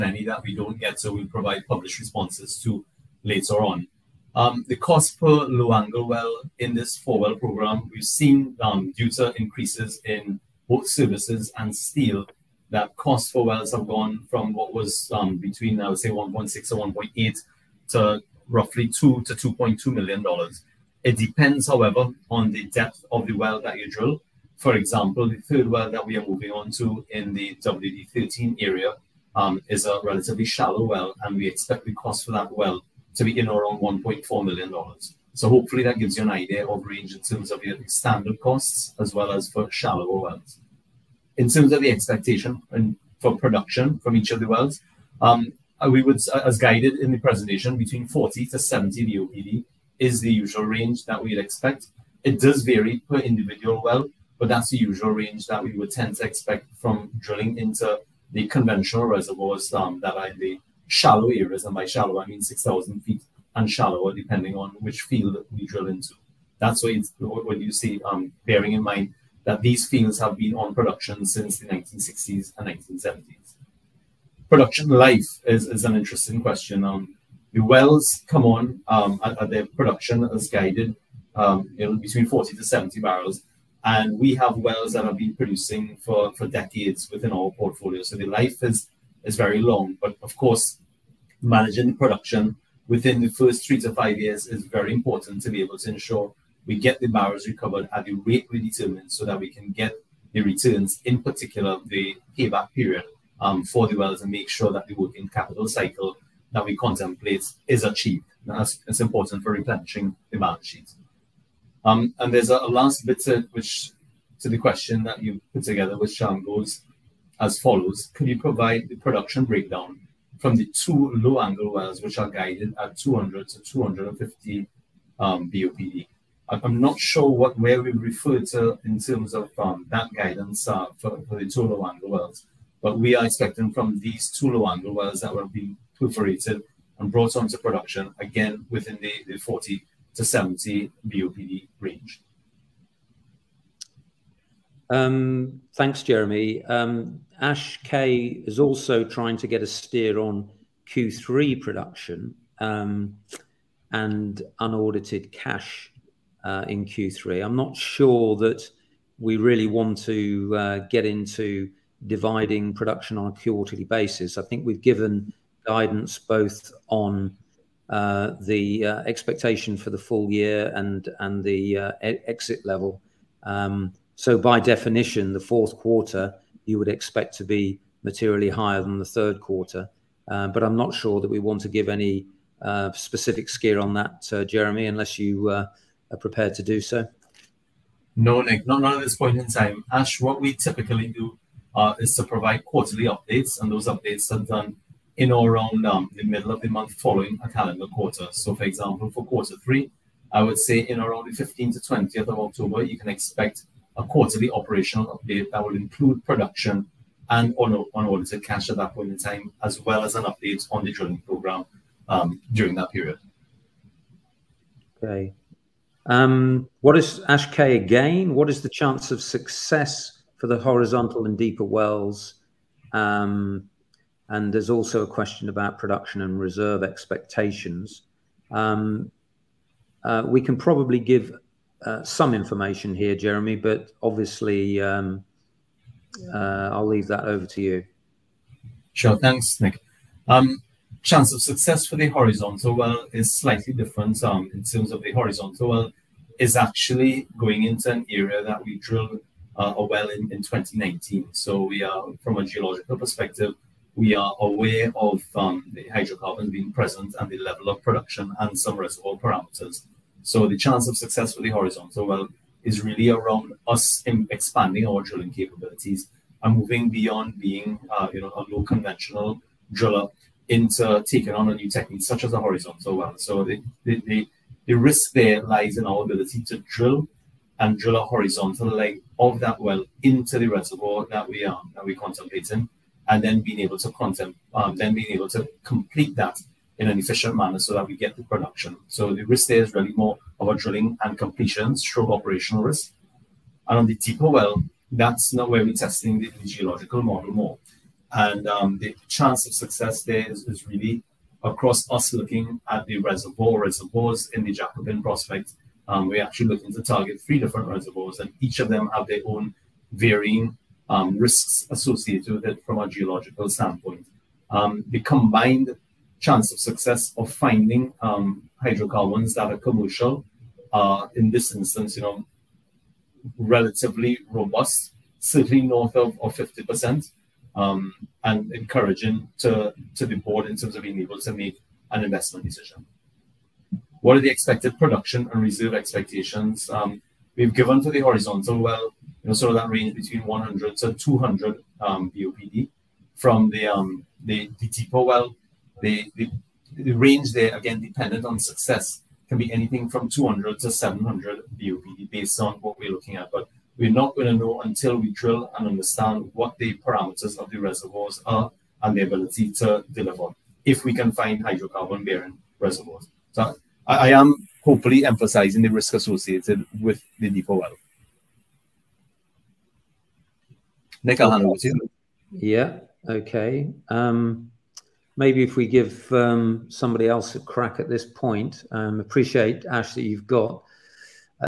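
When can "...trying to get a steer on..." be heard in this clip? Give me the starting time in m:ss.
2:29.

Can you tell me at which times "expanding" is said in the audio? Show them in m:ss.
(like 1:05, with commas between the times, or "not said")
4:24.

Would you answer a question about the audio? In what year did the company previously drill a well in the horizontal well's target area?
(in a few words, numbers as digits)
2019.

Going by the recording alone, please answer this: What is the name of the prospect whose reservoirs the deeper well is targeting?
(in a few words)
Jacobin.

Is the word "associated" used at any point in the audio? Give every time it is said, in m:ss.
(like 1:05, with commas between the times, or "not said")
5:11, 6:05.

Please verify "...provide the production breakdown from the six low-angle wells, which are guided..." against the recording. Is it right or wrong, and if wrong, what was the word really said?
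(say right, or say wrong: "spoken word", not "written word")
wrong: "two", not "six".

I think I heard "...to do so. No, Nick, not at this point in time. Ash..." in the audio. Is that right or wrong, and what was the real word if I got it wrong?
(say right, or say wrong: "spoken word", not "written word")
right.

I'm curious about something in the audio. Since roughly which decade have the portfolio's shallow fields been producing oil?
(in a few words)
1960s.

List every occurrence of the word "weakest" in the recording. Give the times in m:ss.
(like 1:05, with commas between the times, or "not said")
not said.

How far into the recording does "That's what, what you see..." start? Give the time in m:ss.
1:06.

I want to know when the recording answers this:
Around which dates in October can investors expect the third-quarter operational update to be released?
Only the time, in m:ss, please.
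3:21.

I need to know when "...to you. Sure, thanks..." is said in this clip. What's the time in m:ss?
3:57.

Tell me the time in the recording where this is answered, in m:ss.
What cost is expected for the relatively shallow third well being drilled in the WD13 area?
0:33.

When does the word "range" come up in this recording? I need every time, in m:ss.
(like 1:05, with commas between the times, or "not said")
0:36, 0:50, 0:55, 2:21, 5:39, 5:46.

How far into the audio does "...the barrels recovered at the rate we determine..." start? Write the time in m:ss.
1:36.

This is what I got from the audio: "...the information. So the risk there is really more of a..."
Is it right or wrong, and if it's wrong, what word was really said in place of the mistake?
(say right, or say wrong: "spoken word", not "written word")
wrong: "production", not "information".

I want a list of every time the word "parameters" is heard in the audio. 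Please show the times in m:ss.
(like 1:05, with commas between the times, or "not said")
4:19, 5:56.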